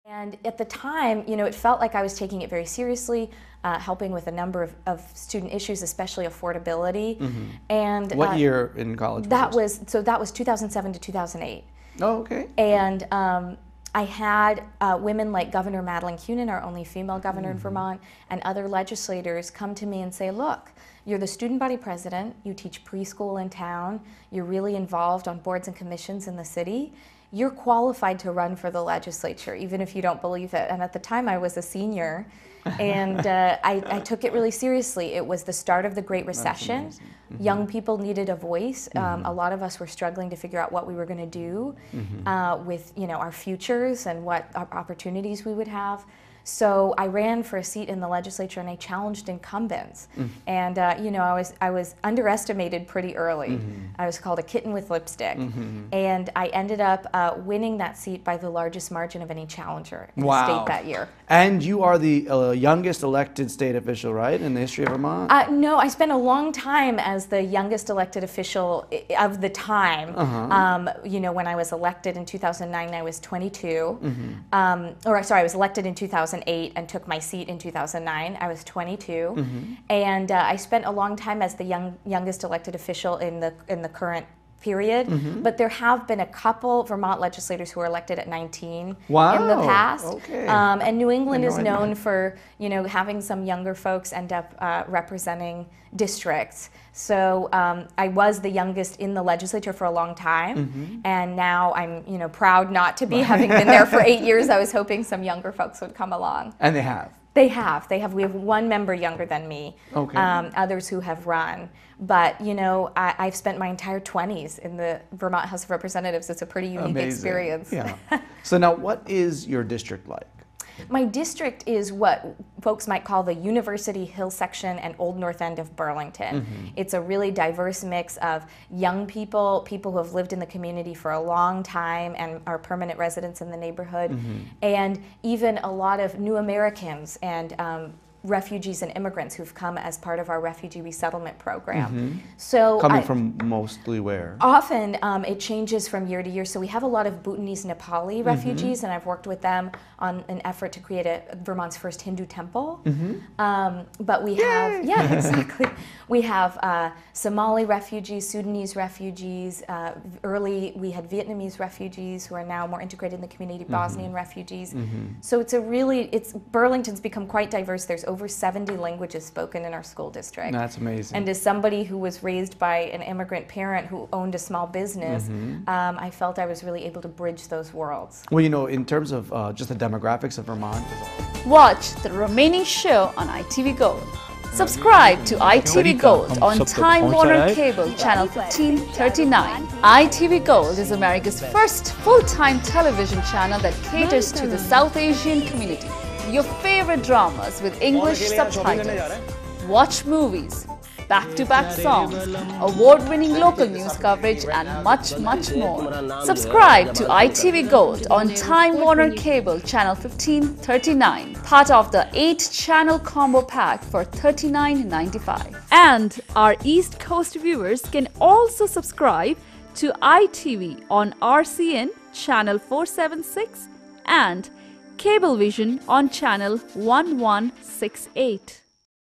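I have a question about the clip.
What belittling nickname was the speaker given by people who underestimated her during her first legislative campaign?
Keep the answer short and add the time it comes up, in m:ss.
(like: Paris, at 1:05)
kitten with lipstick, at 0:54.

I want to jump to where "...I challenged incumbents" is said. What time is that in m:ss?
0:48.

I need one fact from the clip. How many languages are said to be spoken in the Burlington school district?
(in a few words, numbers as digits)
over 70.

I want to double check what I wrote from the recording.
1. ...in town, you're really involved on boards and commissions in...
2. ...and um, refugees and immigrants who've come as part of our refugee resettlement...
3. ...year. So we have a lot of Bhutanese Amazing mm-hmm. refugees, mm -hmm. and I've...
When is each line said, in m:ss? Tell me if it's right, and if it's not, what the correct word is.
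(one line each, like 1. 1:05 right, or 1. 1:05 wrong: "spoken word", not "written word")
1. 0:23 right
2. 2:17 right
3. 2:26 wrong: "Nepali", not "Amazing".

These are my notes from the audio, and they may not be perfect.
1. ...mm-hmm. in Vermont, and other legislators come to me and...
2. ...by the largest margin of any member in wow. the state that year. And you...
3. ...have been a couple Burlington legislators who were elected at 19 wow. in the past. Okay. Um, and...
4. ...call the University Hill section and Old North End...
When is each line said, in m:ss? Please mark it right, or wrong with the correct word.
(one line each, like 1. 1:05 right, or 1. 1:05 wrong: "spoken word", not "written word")
1. 0:17 right
2. 0:58 wrong: "challenger", not "member"
3. 1:25 wrong: "Vermont", not "Burlington"
4. 2:03 right.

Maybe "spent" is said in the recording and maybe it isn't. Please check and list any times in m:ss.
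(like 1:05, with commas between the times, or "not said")
1:05, 1:20, 1:53.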